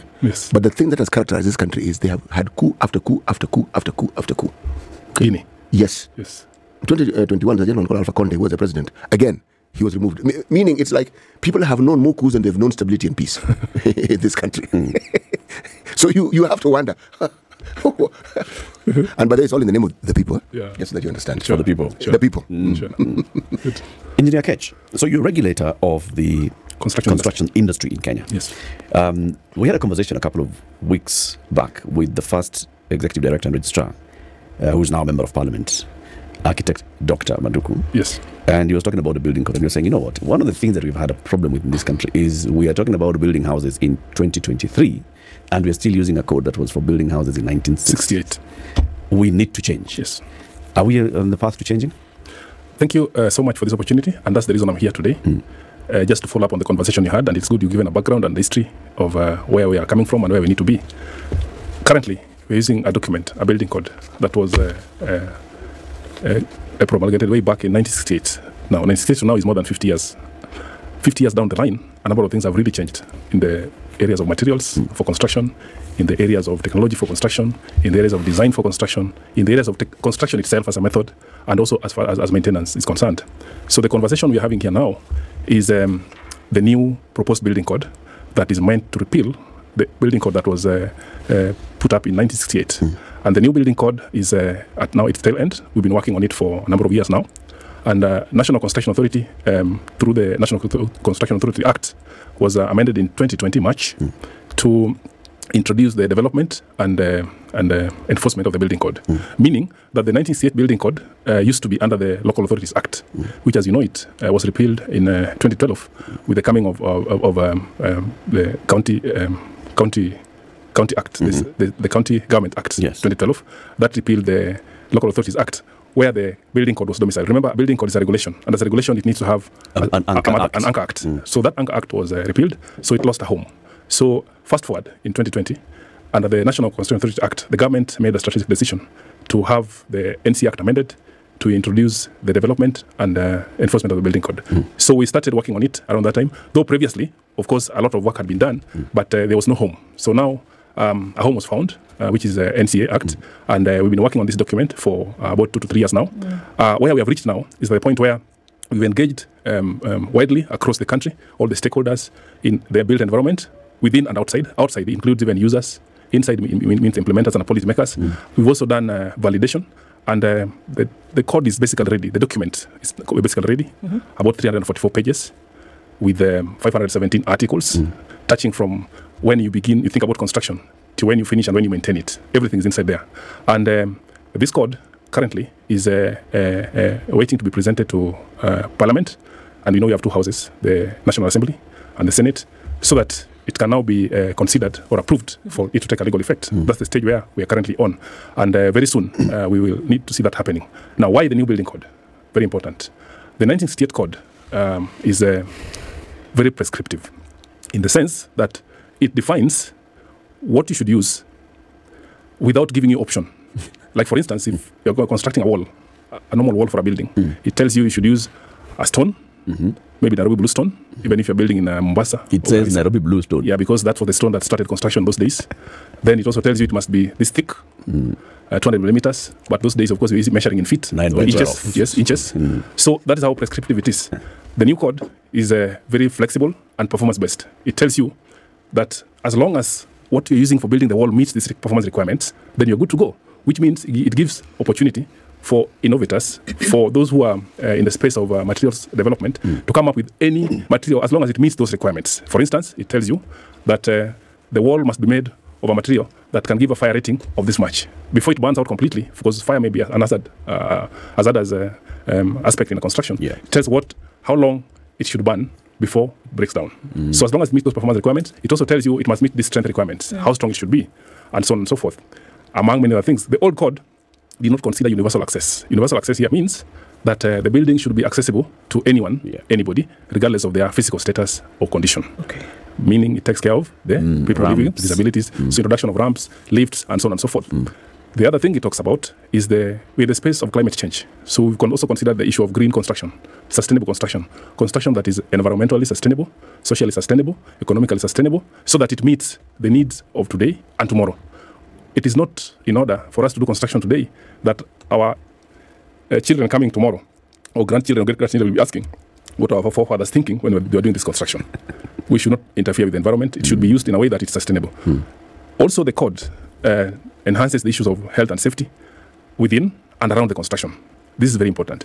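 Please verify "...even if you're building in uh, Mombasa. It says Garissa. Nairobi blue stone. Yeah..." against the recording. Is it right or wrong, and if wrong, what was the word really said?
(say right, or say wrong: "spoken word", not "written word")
right.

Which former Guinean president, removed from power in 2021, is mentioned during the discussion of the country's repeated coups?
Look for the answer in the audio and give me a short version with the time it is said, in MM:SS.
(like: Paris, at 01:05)
Alpha Conde, at 00:07.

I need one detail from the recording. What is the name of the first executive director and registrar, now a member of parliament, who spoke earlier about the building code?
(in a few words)
Manduku.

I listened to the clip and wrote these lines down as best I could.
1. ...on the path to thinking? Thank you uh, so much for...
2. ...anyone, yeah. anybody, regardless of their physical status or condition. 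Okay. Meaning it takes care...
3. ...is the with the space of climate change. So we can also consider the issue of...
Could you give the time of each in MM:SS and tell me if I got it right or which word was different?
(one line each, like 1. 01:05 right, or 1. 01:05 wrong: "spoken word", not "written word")
1. 00:51 wrong: "changing", not "thinking"
2. 04:38 right
3. 04:49 right.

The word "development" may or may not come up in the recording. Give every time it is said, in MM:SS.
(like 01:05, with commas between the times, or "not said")
01:46, 02:22, 04:08.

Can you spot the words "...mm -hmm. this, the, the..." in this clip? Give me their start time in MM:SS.
02:01.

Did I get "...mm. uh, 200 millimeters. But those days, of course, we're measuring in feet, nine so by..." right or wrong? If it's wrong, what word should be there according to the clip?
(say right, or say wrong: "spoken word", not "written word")
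right.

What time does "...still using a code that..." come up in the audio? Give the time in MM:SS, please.
00:45.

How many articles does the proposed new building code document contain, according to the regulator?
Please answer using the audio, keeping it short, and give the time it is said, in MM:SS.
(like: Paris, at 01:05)
517, at 02:56.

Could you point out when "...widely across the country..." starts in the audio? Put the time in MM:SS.
02:40.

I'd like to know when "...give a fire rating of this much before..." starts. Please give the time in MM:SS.
04:16.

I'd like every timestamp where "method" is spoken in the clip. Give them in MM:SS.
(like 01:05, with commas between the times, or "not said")
01:20.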